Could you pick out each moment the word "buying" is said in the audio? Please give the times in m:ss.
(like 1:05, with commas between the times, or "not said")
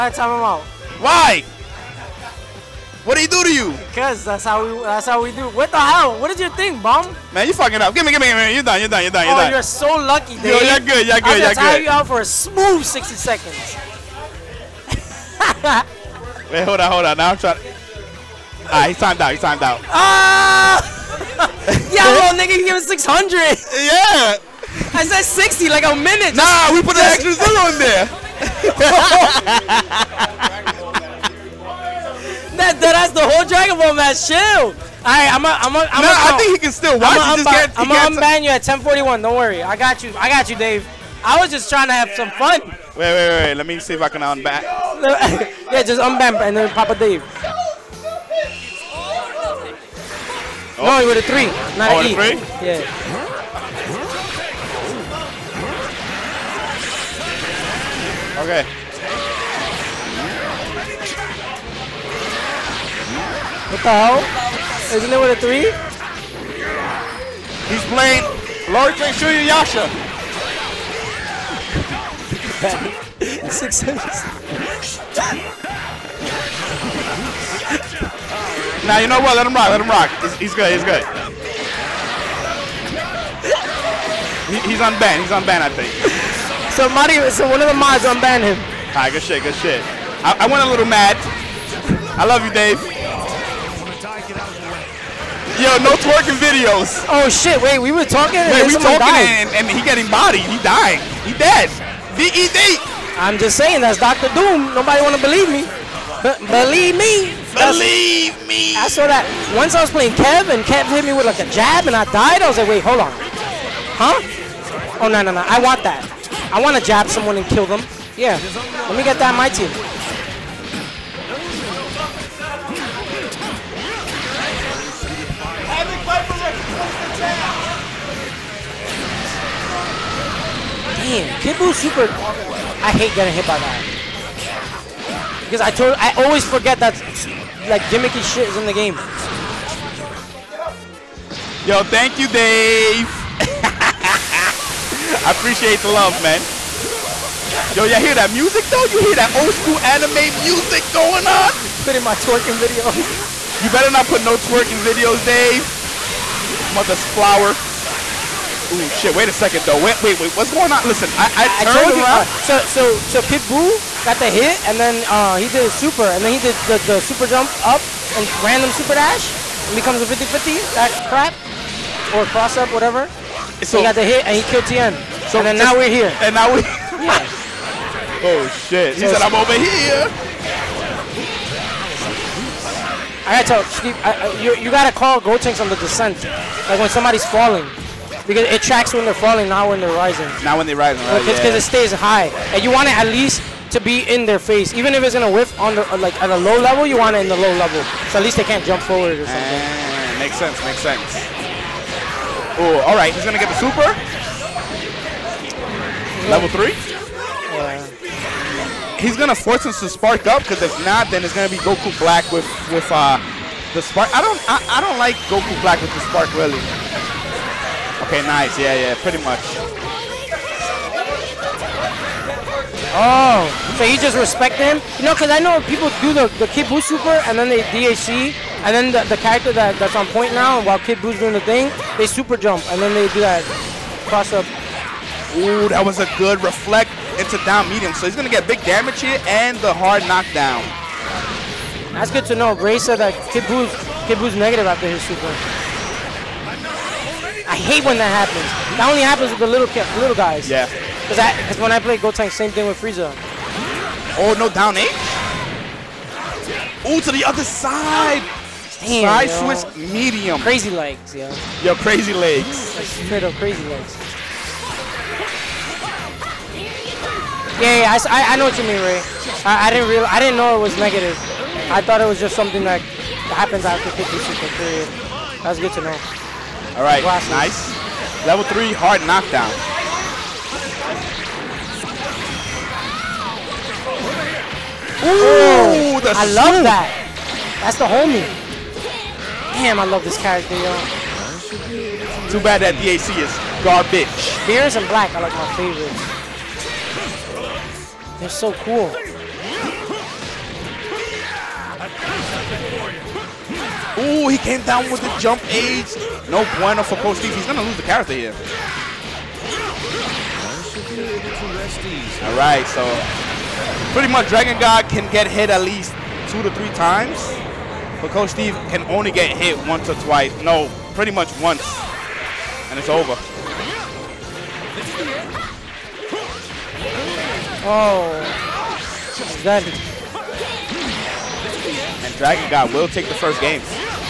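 not said.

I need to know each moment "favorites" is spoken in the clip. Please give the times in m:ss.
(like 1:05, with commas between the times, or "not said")
4:55.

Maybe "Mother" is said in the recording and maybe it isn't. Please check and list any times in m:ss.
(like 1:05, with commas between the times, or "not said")
2:36.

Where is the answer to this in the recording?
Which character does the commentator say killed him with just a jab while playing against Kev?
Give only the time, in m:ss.
1:44.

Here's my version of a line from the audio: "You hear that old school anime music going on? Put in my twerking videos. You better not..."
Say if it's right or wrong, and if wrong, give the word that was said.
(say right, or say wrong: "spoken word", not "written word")
right.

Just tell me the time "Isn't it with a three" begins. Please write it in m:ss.
1:04.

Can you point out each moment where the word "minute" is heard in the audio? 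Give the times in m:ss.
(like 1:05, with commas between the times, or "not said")
0:25.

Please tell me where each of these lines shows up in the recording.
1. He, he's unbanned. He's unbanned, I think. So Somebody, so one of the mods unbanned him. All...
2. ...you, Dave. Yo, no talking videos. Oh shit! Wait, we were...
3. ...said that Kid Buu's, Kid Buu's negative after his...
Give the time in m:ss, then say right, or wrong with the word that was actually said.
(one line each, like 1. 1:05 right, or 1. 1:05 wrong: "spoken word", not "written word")
1. 1:24 right
2. 1:32 wrong: "twerking", not "talking"
3. 4:02 right.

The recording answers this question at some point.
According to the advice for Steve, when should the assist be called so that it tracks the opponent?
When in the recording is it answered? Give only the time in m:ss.
3:05.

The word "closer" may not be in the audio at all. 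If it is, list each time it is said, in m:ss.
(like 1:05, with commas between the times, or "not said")
not said.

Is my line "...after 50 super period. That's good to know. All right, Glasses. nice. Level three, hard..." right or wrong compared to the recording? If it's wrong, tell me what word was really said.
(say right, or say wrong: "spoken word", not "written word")
right.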